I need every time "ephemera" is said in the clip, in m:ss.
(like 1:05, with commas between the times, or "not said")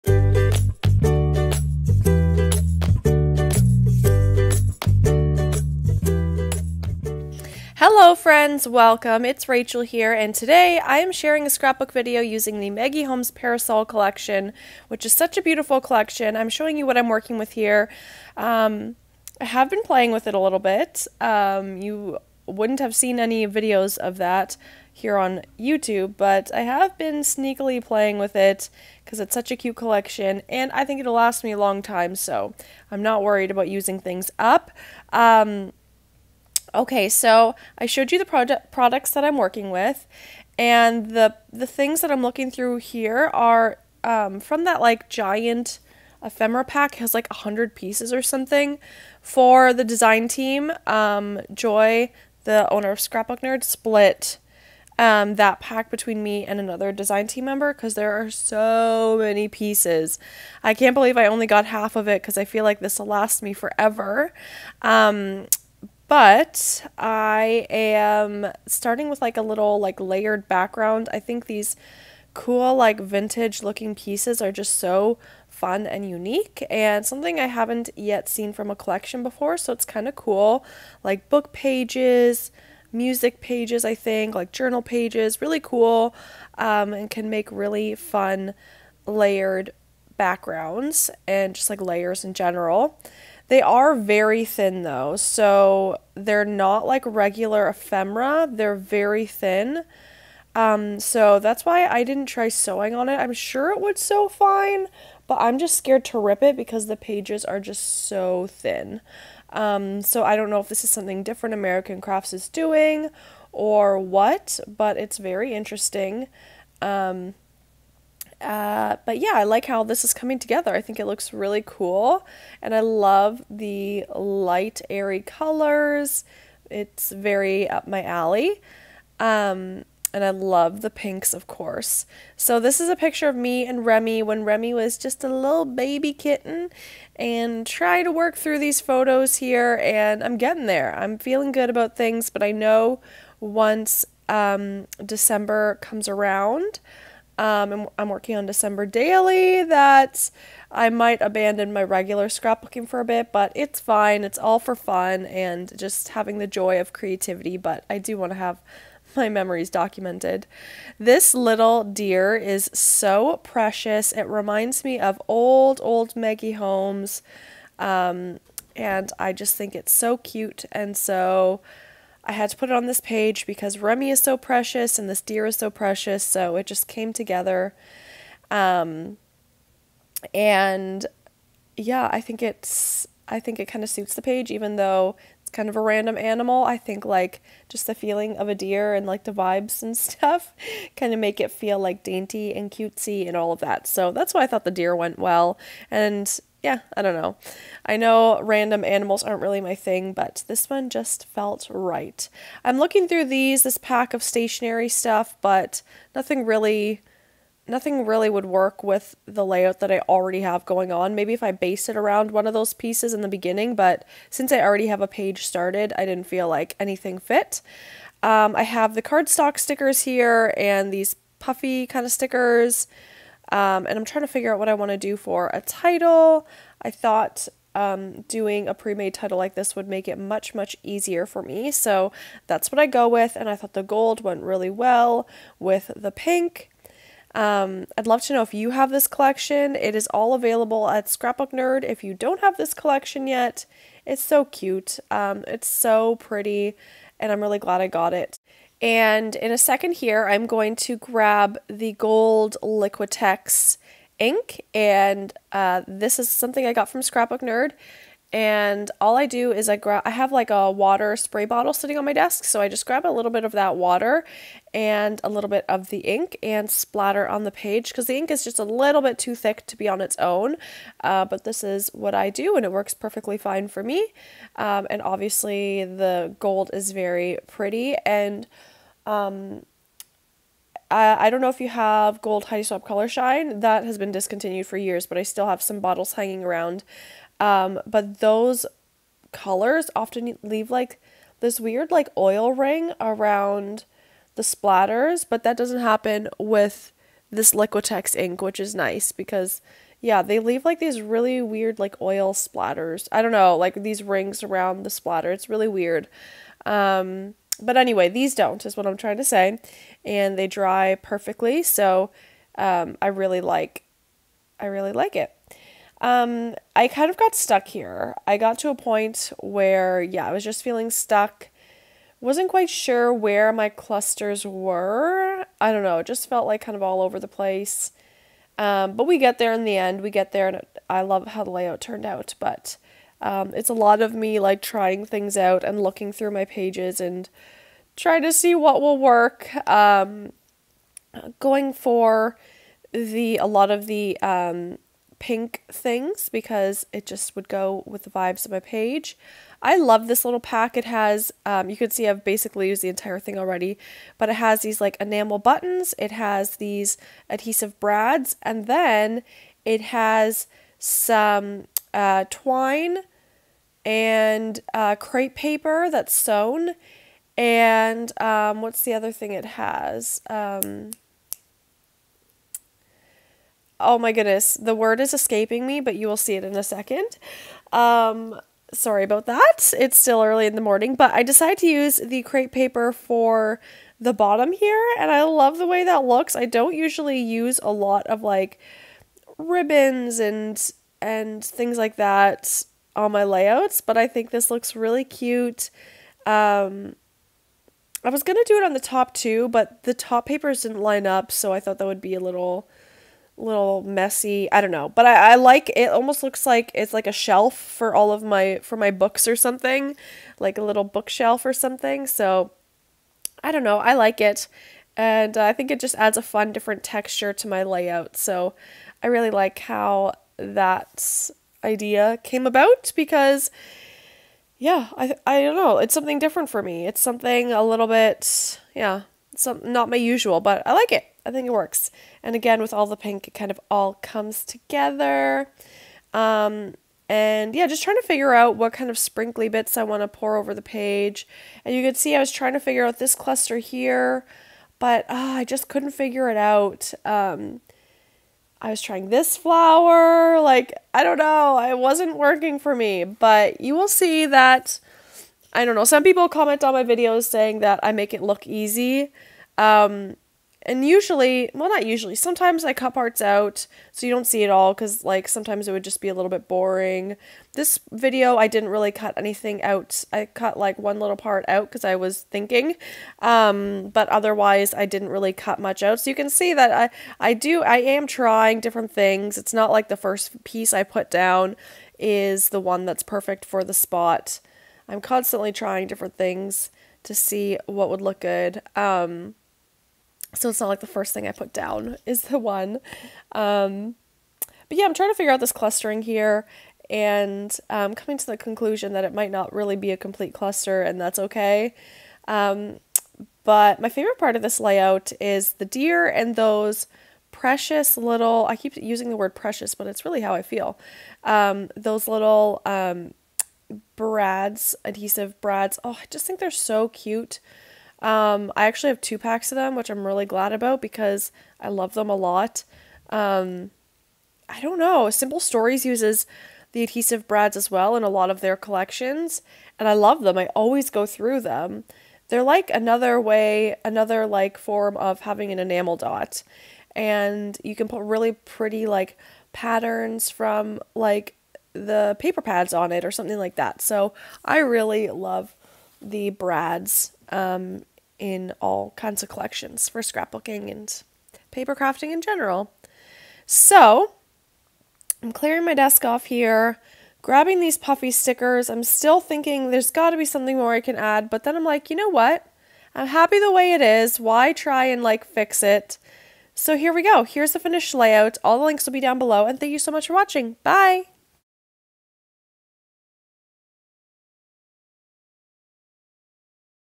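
0:46, 1:37.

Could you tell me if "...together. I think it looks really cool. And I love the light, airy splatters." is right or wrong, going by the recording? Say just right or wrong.
wrong.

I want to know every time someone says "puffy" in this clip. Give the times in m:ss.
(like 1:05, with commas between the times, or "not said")
3:41, 9:17.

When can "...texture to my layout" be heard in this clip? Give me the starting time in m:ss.
6:56.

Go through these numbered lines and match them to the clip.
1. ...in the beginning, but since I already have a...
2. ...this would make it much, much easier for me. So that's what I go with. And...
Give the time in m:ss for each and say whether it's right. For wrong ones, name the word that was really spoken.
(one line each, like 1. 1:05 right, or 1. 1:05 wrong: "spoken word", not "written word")
1. 3:33 right
2. 3:49 right.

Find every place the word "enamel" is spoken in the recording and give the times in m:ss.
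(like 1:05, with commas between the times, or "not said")
5:54, 8:55.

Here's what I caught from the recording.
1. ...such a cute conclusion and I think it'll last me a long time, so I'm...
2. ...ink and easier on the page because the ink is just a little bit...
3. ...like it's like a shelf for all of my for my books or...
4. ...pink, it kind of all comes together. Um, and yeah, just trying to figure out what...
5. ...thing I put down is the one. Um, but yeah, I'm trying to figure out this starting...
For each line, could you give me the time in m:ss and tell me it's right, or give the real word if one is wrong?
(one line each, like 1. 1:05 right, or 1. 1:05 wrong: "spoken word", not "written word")
1. 0:29 wrong: "collection", not "conclusion"
2. 4:25 wrong: "splatter", not "easier"
3. 6:46 right
4. 7:12 right
5. 8:11 wrong: "clustering", not "starting".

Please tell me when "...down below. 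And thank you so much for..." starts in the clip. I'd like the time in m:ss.
9:28.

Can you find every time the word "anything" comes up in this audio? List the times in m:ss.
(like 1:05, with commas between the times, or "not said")
3:36, 7:49.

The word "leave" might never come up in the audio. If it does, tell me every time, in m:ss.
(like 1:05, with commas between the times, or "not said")
4:50, 5:00.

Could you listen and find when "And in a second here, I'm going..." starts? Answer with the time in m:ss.
4:08.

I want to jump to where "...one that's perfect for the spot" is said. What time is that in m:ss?
8:02.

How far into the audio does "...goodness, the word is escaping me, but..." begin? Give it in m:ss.
6:14.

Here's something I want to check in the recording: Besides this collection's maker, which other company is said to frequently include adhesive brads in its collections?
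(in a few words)
Simple Stories.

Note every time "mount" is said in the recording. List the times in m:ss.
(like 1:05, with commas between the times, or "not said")
not said.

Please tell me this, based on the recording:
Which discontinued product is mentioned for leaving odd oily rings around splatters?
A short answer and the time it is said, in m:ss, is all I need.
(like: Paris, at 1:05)
Heidi Swapp Color Shine, at 4:42.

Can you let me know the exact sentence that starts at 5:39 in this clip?
Um, going for the a lot of the um, pink things because it just would go with the vibes of my page.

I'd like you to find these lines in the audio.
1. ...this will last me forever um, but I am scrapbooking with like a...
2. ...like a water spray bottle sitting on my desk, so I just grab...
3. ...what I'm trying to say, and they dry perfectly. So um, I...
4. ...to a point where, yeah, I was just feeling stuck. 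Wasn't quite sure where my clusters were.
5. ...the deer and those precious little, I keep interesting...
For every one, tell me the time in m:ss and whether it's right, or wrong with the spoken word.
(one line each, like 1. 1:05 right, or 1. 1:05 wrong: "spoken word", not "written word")
1. 1:02 wrong: "starting", not "scrapbooking"
2. 4:20 right
3. 5:08 right
4. 5:18 right
5. 8:25 wrong: "using", not "interesting".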